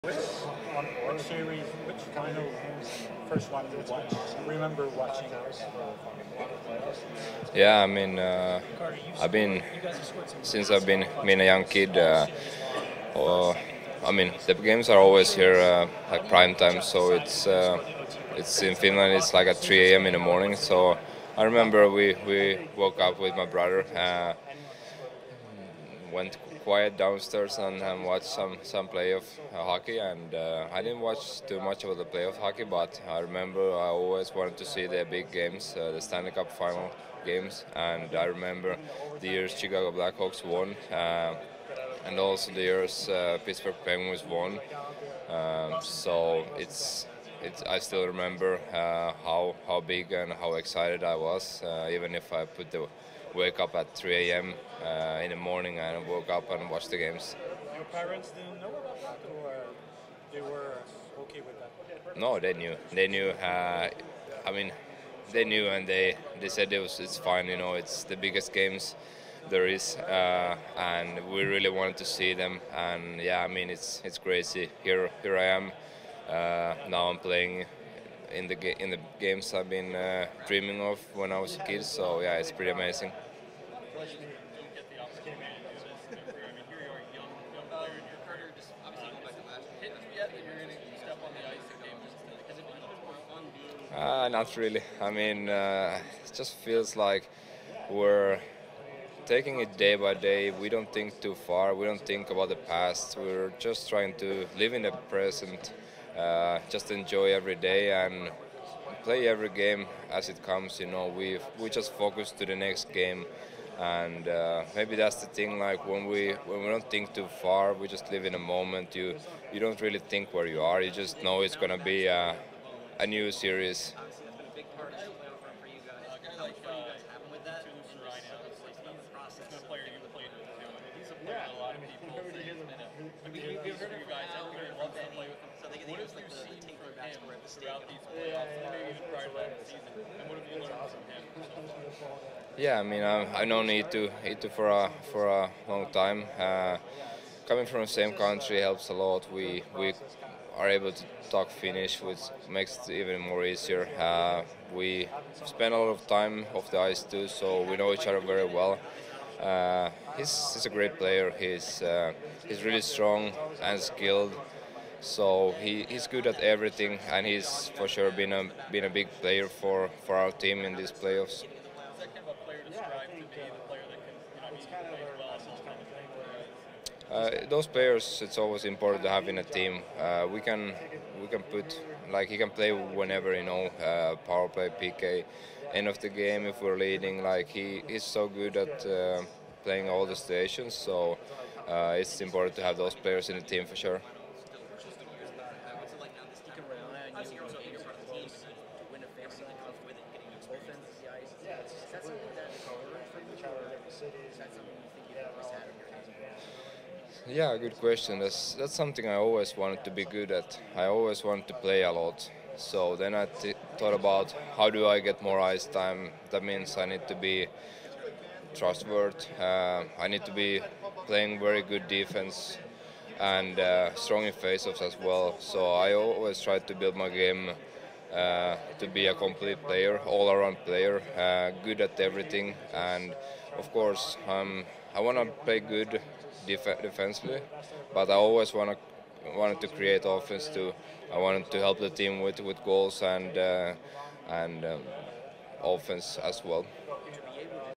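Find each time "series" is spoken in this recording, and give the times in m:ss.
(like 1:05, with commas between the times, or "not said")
0:01, 2:03.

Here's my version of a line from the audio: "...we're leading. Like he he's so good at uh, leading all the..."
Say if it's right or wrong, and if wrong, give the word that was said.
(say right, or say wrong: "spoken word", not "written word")
wrong: "playing", not "leading".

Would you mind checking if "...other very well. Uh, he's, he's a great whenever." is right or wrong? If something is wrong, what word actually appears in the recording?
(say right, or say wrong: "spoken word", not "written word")
wrong: "player", not "whenever".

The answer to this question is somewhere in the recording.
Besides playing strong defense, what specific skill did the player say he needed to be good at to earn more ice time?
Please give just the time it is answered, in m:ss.
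3:44.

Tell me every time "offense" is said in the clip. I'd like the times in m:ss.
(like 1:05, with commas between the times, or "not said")
4:00, 4:05.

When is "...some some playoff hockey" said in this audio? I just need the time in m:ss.
0:28.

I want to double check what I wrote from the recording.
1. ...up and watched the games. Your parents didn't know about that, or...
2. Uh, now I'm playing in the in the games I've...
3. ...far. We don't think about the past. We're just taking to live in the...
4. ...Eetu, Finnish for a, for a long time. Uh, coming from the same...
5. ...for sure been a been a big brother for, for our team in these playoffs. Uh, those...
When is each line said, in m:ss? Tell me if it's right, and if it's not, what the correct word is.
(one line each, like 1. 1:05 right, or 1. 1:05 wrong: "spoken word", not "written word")
1. 0:56 right
2. 1:16 right
3. 1:41 wrong: "trying", not "taking"
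4. 2:23 wrong: "Eetu", not "Finnish"
5. 2:47 wrong: "player", not "brother".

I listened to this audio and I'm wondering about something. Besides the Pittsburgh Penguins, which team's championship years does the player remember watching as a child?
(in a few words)
Chicago Blackhawks.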